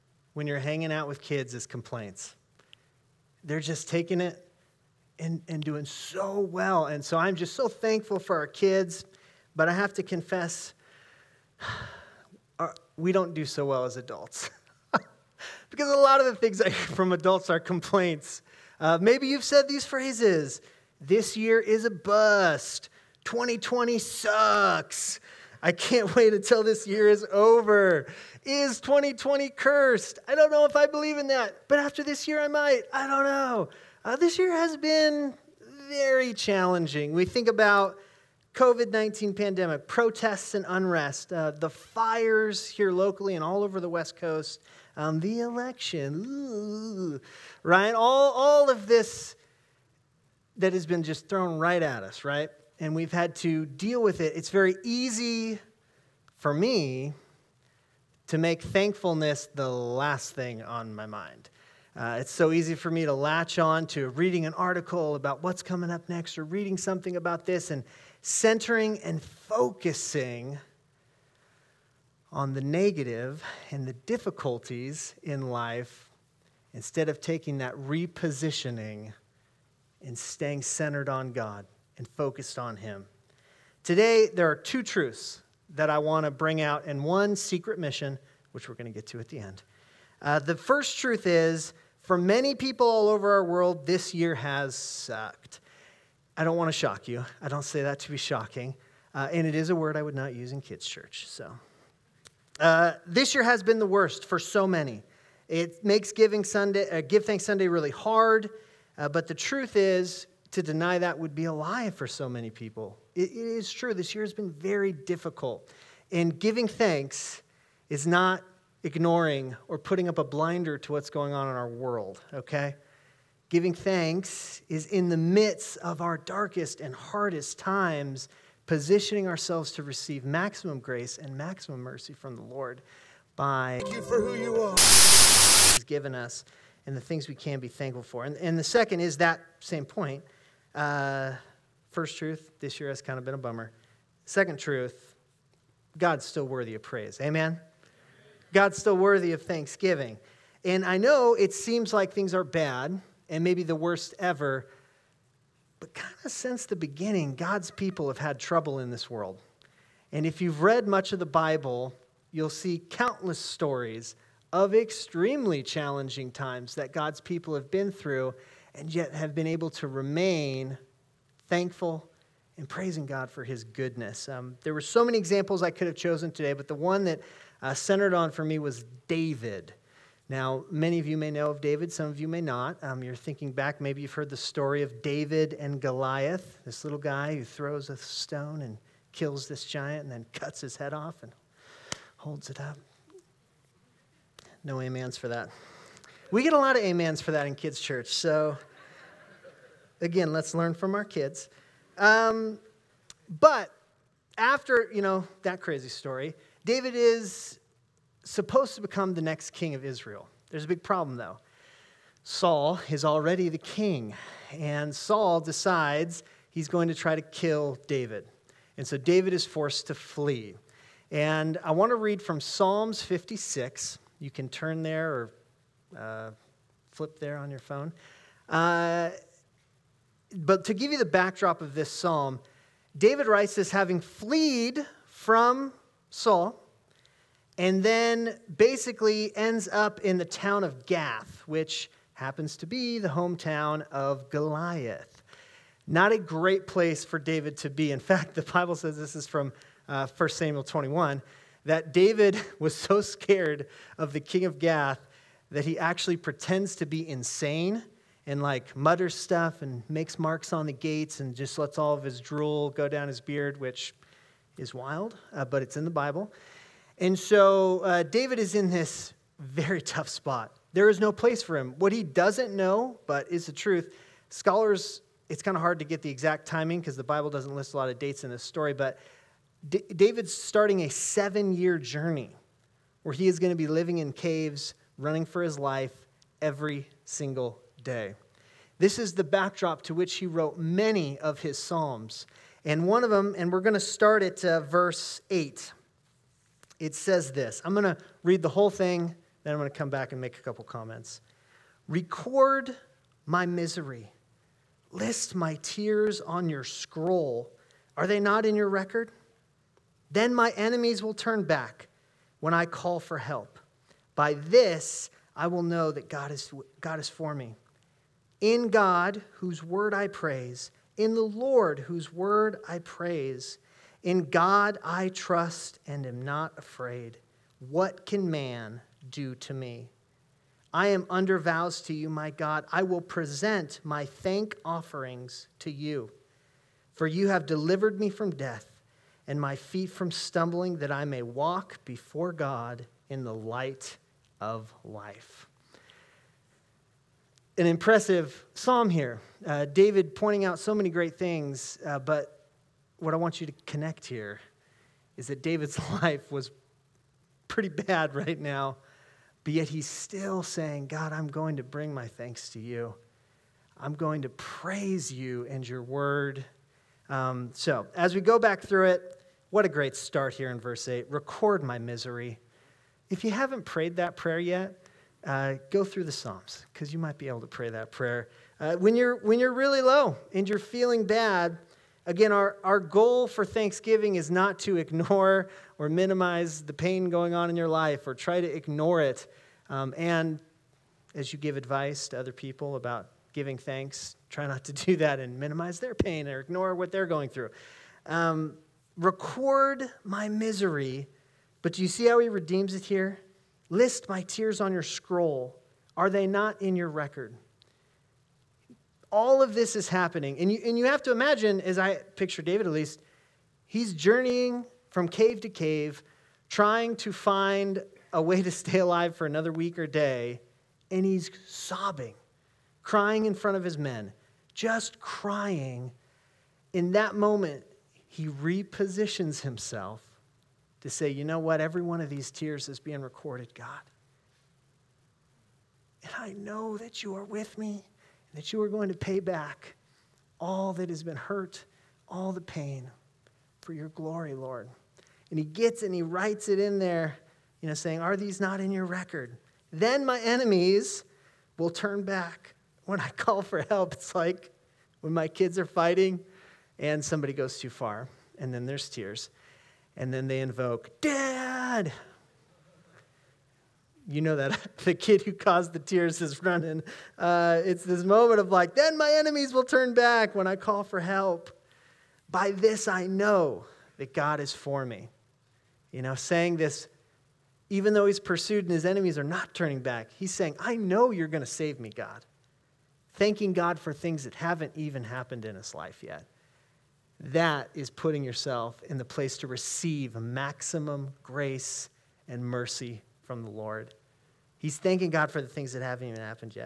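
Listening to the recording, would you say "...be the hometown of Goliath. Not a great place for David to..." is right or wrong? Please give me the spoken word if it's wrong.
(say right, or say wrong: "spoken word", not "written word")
right.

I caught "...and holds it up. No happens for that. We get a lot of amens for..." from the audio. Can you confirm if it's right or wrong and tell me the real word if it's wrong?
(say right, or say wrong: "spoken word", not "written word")
wrong: "amens", not "happens".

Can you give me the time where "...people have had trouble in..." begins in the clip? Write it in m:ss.
2:37.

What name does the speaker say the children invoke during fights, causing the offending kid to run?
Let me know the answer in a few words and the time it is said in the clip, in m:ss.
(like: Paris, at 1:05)
Dad, at 7:40.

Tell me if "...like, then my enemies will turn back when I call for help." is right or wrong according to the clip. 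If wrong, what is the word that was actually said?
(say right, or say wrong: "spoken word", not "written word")
right.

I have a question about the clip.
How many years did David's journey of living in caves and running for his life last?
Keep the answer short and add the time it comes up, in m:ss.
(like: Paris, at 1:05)
7, at 4:40.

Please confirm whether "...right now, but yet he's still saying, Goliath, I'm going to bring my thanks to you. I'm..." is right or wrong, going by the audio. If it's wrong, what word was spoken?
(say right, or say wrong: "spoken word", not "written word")
wrong: "God", not "Goliath".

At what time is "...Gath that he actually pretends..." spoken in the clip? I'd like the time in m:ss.
4:14.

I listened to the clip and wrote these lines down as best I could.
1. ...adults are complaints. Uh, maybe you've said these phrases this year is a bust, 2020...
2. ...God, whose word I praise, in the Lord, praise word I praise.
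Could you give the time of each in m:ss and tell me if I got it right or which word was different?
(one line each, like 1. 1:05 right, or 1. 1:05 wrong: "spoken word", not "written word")
1. 0:17 right
2. 5:18 wrong: "whose", not "praise".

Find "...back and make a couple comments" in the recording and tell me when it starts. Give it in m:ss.
4:59.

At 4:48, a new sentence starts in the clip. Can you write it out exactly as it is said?
This is the backdrop to which he wrote many of his Psalms.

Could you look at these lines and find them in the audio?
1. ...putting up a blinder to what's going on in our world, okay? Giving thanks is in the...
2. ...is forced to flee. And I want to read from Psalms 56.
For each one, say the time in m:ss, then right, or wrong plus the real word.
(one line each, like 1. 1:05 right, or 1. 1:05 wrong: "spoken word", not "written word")
1. 1:59 right
2. 3:39 right.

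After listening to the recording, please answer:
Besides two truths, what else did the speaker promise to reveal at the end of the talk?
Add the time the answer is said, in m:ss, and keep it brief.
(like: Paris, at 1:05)
secret mission, at 1:27.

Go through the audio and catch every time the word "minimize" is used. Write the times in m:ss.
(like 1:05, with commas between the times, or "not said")
6:25, 6:35.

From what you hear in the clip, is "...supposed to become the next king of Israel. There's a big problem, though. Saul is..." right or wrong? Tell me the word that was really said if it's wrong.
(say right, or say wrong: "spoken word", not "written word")
right.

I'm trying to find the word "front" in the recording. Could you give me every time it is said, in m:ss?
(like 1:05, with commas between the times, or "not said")
7:03.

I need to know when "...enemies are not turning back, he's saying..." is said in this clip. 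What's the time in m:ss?
7:58.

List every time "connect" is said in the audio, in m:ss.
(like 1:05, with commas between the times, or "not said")
5:53.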